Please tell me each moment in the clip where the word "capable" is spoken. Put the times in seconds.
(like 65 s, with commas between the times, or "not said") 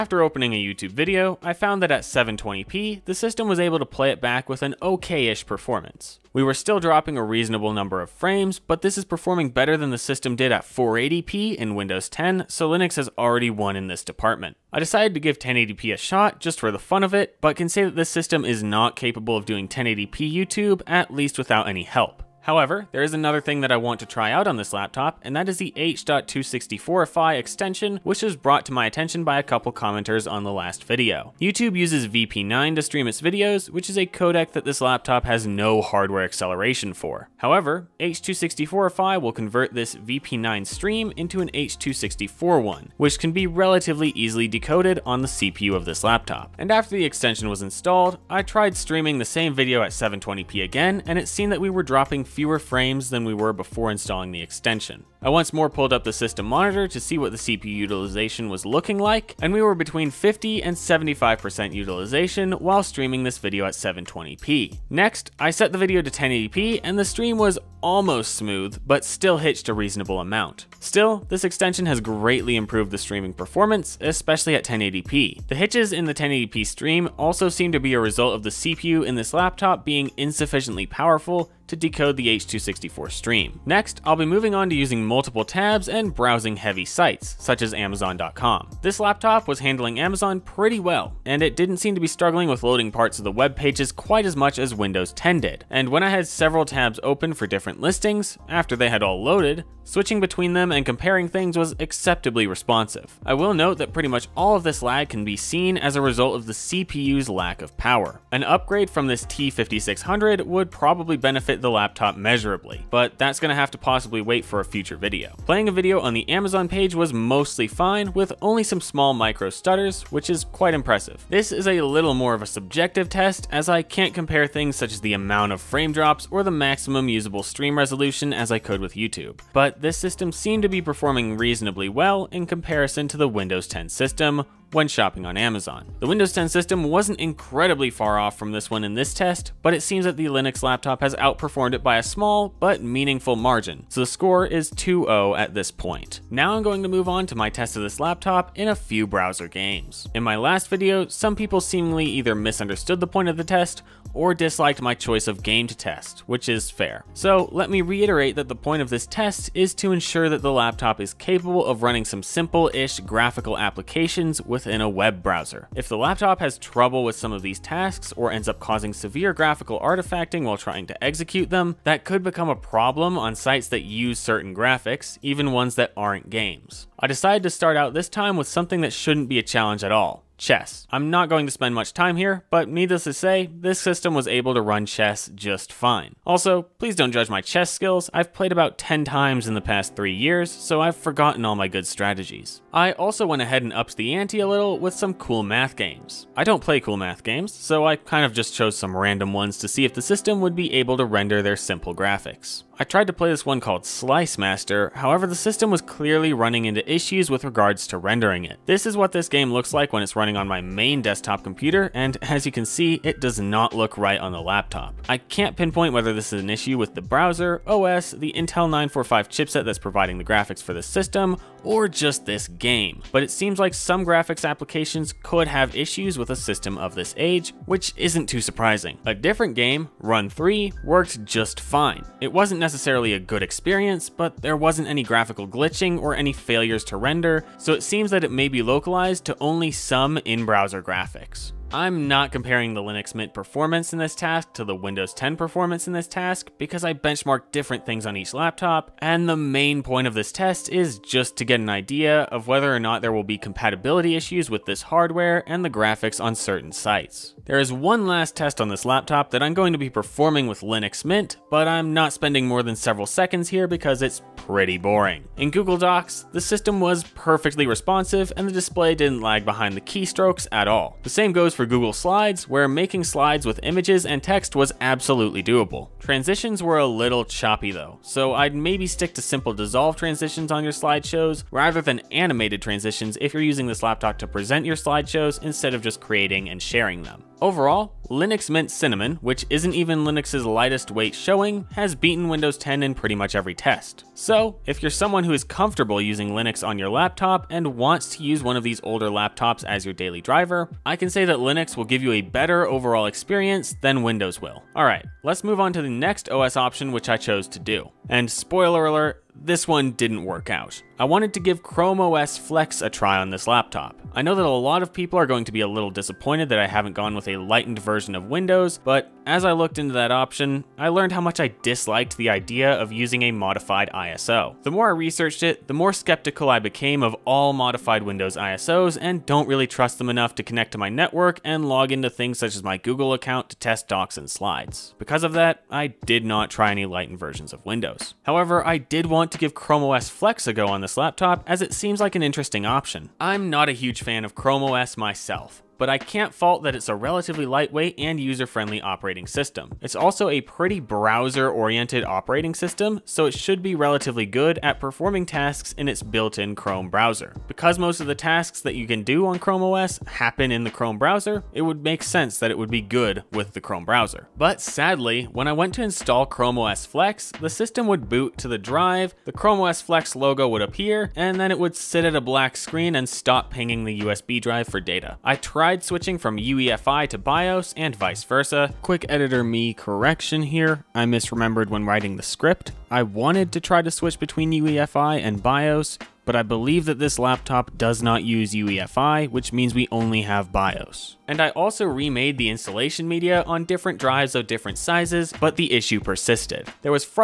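18 s, 161 s.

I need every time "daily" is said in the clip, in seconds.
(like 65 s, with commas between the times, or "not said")
299 s.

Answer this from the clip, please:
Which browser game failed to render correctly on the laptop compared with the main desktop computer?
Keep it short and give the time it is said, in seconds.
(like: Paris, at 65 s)
Slice Master, at 203 s.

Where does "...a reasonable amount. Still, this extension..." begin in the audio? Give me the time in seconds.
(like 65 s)
69 s.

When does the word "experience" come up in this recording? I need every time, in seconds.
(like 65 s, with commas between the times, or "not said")
233 s, 303 s.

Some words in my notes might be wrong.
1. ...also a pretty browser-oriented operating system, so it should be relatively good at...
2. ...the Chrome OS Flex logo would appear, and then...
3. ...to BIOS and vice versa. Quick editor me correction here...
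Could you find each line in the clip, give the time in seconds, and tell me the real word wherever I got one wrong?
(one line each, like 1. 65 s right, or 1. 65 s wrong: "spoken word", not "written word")
1. 349 s right
2. 369 s right
3. 377 s right.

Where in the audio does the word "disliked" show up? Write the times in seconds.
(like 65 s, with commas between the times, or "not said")
154 s, 321 s.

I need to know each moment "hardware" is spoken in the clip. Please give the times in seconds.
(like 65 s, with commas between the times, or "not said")
35 s, 254 s.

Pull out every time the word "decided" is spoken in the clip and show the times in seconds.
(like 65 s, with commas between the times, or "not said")
14 s, 177 s.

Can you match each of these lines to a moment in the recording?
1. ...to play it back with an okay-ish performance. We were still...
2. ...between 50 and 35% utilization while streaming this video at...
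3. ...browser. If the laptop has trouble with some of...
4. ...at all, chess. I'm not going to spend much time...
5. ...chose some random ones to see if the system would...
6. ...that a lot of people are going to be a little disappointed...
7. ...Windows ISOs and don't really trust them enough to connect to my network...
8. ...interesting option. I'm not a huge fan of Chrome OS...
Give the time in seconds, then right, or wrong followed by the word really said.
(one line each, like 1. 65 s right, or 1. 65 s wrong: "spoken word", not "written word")
1. 3 s right
2. 59 s wrong: "75", not "35"
3. 165 s right
4. 179 s right
5. 198 s right
6. 314 s right
7. 328 s right
8. 342 s right.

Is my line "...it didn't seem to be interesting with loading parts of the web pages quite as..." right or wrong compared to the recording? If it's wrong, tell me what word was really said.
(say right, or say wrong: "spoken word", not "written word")
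wrong: "struggling", not "interesting".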